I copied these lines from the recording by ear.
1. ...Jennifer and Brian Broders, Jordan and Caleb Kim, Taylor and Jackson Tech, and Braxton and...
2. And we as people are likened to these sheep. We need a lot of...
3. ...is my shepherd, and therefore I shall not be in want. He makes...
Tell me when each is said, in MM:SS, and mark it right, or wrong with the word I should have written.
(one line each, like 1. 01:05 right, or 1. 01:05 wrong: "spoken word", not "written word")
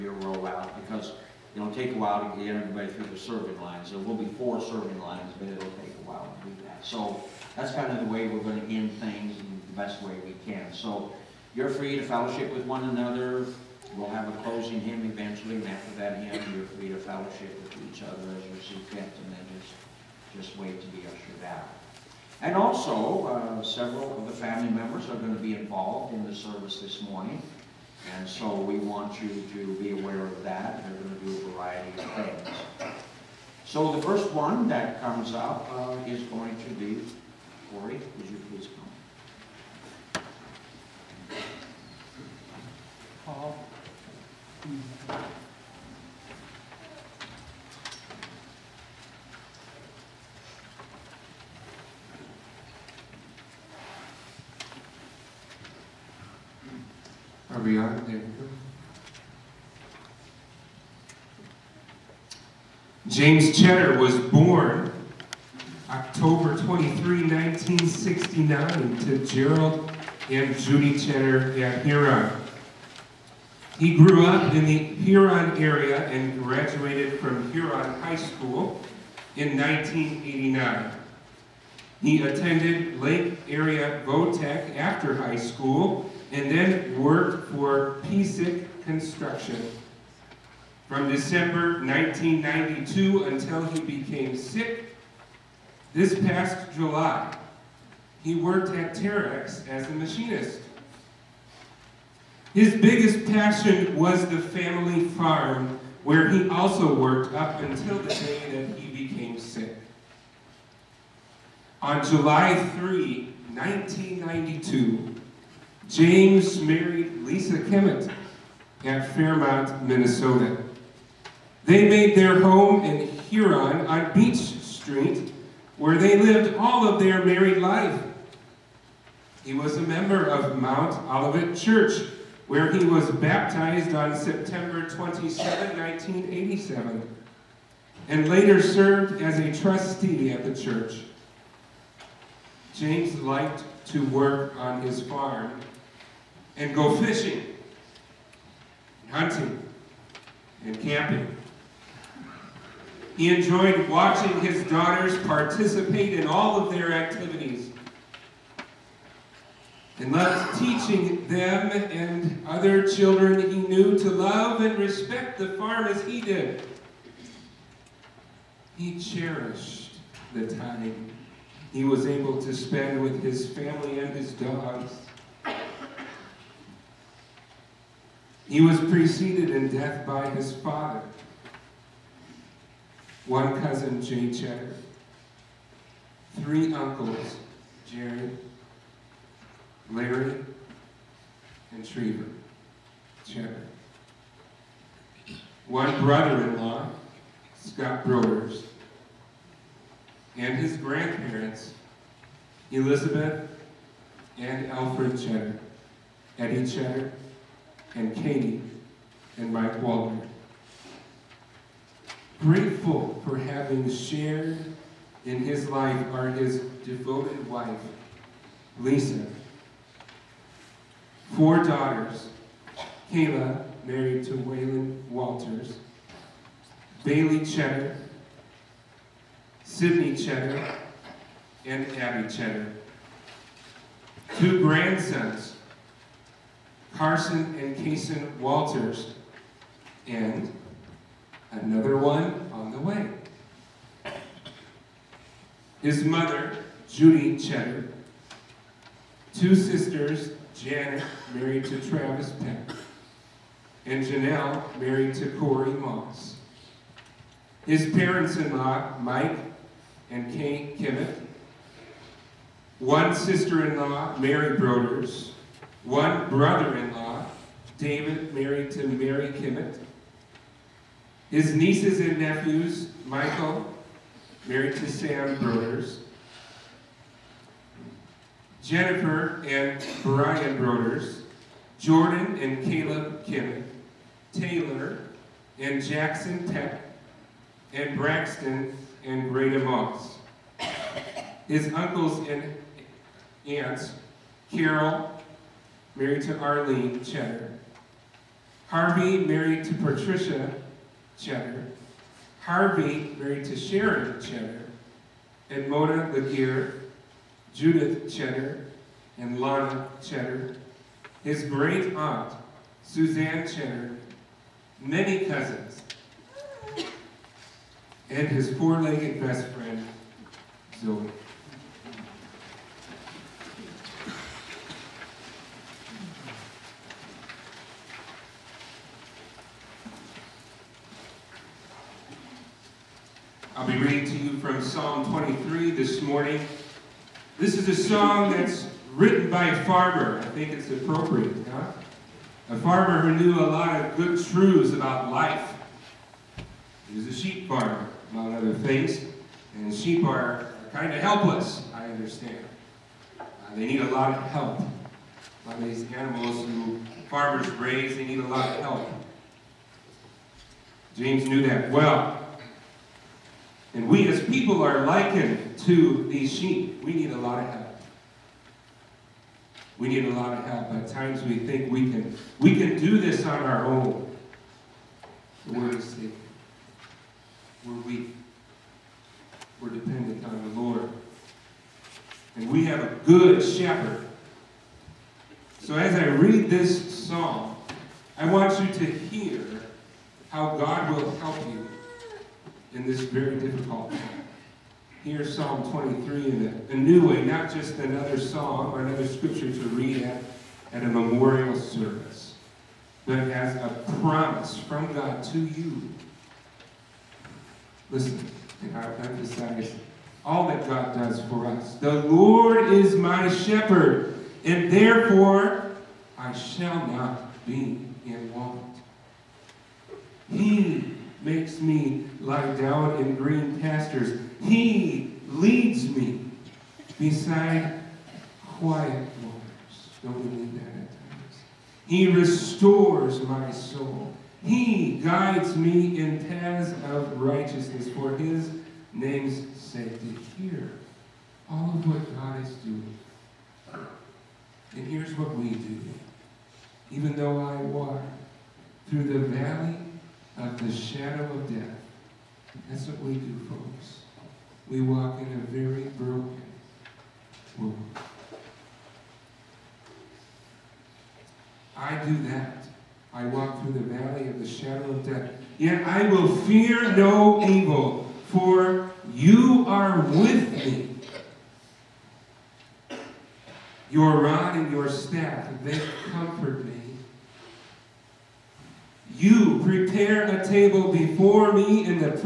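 1. 04:38 right
2. 06:03 right
3. 06:52 right.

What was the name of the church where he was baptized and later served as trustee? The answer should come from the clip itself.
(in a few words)
Mount Olivet Church.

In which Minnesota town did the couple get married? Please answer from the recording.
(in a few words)
Fairmont.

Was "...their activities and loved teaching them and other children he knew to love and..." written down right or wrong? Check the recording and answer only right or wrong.
right.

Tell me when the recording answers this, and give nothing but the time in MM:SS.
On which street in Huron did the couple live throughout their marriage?
02:04.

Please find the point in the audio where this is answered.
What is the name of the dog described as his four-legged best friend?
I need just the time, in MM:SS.
05:20.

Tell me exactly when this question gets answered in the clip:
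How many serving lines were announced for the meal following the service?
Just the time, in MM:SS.
00:04.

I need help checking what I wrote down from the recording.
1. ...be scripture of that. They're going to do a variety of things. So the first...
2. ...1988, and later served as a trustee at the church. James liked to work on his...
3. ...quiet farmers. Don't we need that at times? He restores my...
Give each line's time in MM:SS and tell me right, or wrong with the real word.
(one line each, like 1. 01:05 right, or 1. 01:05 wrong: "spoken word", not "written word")
1. 00:29 wrong: "aware", not "scripture"
2. 02:15 wrong: "1987", not "1988"
3. 07:08 wrong: "waters", not "farmers".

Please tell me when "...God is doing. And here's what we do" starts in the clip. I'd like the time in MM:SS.
07:22.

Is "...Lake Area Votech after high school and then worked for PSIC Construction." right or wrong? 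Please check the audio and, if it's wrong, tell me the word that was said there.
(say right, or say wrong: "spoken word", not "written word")
right.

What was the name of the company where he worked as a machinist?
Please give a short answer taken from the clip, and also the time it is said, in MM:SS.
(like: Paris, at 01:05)
Terex, at 01:38.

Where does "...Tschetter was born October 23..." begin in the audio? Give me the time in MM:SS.
01:03.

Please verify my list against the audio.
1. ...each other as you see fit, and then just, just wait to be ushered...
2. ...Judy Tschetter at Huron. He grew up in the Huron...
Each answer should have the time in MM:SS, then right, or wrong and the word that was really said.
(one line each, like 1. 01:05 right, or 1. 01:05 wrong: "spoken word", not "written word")
1. 00:17 right
2. 01:10 right.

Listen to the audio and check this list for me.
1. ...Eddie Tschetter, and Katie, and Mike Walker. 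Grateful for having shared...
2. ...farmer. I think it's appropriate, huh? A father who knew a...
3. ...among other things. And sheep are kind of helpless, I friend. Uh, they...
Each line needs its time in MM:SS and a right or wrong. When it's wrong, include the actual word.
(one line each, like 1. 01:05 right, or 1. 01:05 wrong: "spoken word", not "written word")
1. 03:26 right
2. 05:39 wrong: "farmer", not "father"
3. 05:48 wrong: "understand", not "friend".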